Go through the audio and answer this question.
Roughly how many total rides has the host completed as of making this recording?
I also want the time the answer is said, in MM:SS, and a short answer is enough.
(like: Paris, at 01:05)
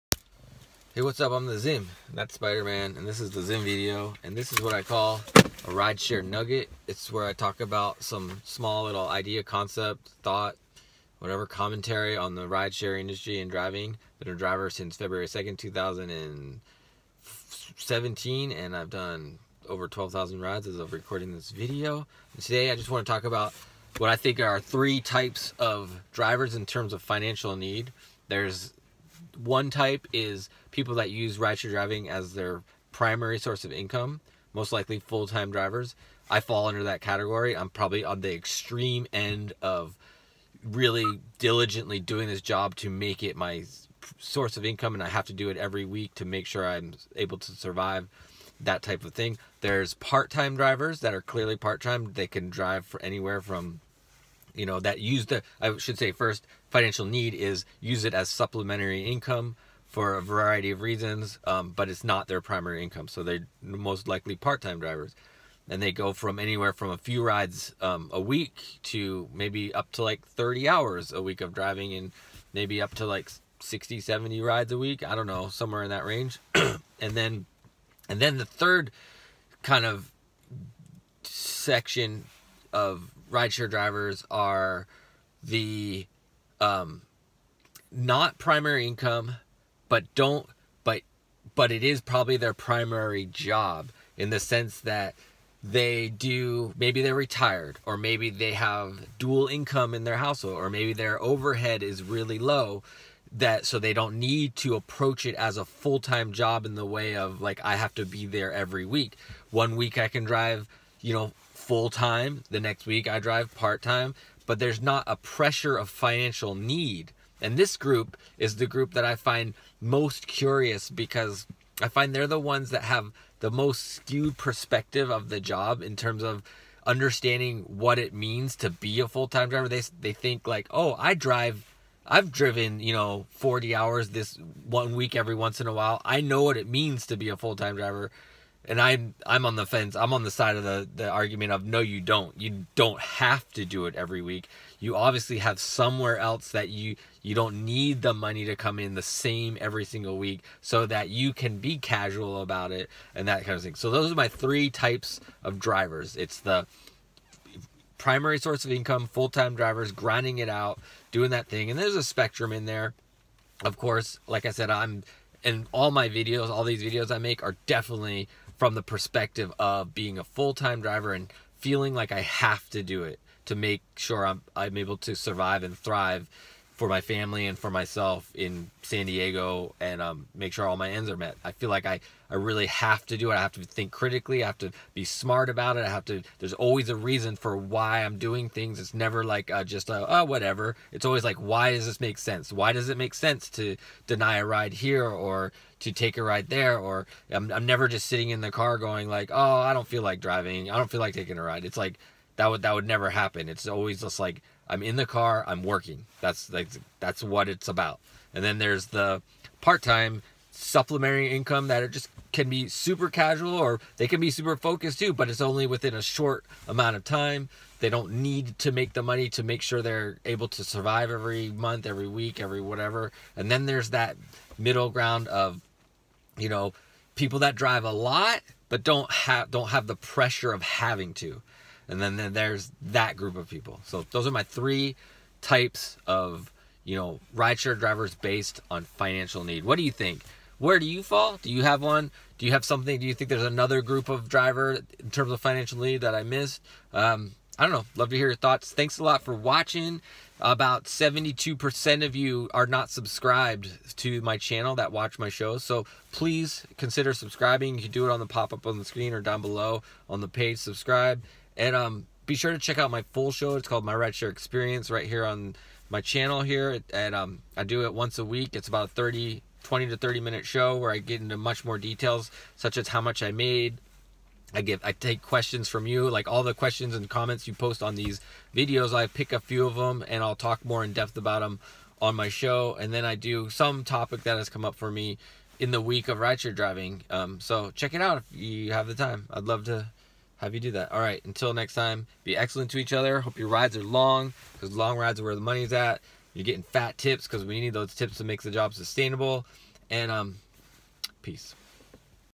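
12,000, at 00:19.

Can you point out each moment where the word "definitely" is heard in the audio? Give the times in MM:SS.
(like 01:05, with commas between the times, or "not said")
02:47.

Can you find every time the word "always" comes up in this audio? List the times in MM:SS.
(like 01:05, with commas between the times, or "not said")
03:06, 03:11, 03:23.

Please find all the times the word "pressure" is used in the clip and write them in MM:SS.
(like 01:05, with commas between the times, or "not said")
01:55, 03:49.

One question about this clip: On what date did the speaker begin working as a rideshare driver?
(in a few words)
February 2, 2017.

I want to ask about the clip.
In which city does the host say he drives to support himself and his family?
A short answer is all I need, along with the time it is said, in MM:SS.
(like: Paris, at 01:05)
San Diego, at 02:58.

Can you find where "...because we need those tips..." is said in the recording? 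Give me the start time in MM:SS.
04:57.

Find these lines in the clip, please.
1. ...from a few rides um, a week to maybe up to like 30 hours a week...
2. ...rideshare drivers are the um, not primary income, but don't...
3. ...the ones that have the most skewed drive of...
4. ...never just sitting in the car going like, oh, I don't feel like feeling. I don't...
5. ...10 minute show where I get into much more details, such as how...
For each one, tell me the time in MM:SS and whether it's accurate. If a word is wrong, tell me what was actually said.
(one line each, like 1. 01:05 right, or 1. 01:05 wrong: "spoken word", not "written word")
1. 01:06 right
2. 01:23 right
3. 02:02 wrong: "perspective", not "drive"
4. 03:17 wrong: "driving", not "feeling"
5. 04:29 wrong: "30", not "10".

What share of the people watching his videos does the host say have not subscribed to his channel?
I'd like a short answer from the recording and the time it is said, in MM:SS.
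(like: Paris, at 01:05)
72%, at 04:10.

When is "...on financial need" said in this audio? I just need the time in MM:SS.
03:58.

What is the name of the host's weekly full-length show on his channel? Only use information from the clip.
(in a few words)
My Rideshare Experience.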